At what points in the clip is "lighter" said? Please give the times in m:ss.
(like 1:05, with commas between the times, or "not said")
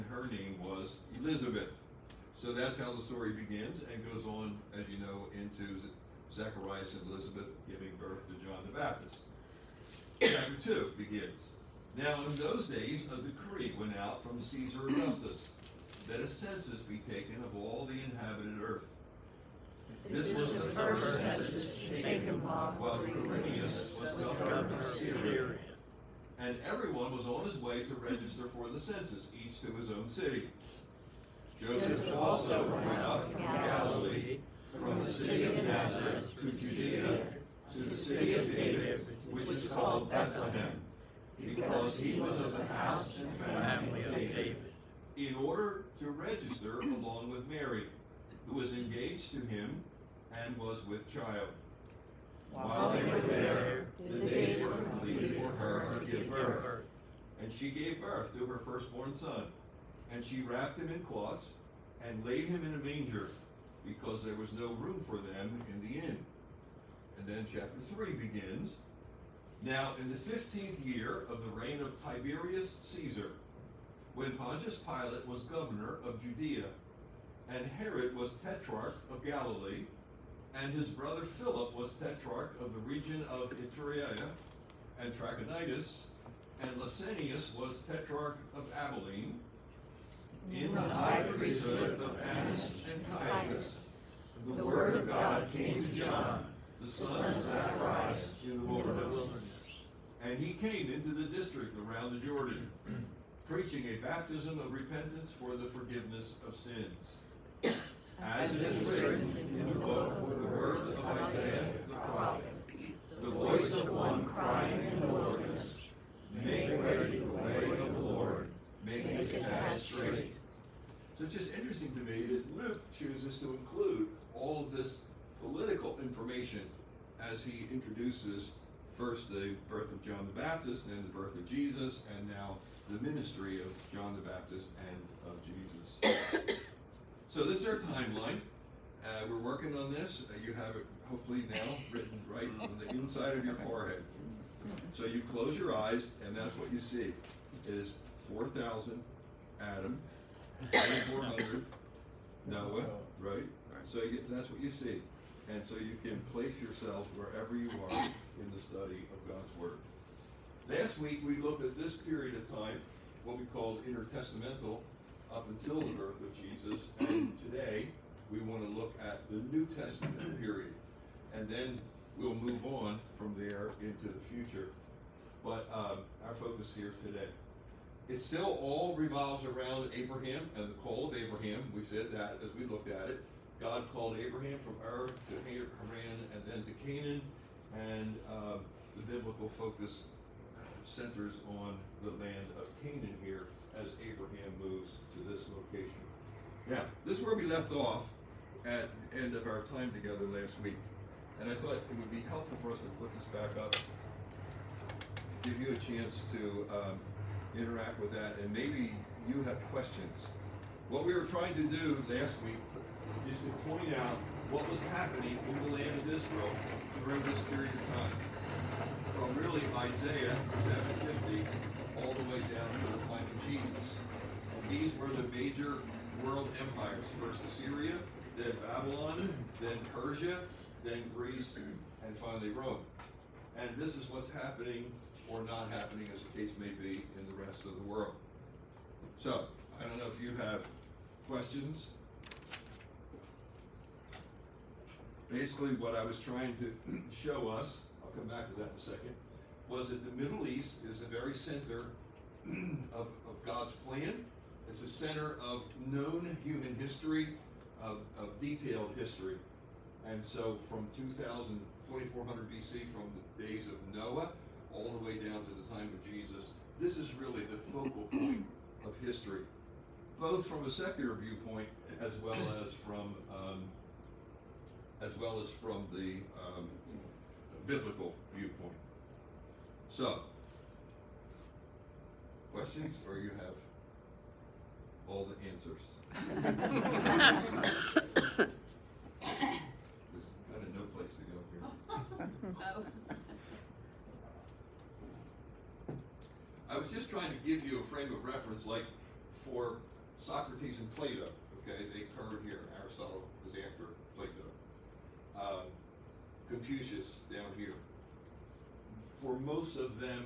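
not said.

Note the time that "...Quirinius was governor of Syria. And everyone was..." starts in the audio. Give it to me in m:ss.
0:23.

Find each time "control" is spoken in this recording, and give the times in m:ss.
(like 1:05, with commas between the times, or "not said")
not said.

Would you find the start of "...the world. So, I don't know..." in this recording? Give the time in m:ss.
3:57.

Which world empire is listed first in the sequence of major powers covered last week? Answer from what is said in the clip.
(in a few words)
Assyria.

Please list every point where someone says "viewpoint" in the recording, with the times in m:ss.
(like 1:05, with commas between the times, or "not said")
4:31, 4:38.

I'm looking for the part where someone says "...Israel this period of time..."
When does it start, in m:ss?
3:36.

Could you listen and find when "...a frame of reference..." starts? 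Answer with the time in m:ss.
4:57.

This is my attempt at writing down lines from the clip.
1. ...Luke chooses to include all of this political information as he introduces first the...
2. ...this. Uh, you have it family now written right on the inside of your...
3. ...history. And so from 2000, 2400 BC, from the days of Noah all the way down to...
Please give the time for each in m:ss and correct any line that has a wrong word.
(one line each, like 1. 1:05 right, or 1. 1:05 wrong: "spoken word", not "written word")
1. 2:02 right
2. 2:19 wrong: "hopefully", not "family"
3. 4:18 right.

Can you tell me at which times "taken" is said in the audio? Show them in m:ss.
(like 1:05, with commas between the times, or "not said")
0:17, 0:21.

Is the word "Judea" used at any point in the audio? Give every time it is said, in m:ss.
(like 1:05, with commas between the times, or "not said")
0:36, 1:16.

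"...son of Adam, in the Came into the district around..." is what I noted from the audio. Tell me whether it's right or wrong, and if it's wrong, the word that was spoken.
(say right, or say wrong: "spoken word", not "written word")
wrong: "Zacharias", not "Adam".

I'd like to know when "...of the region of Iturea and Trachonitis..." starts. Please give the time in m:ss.
1:22.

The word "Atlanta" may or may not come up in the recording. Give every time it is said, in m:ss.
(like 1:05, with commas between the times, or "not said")
not said.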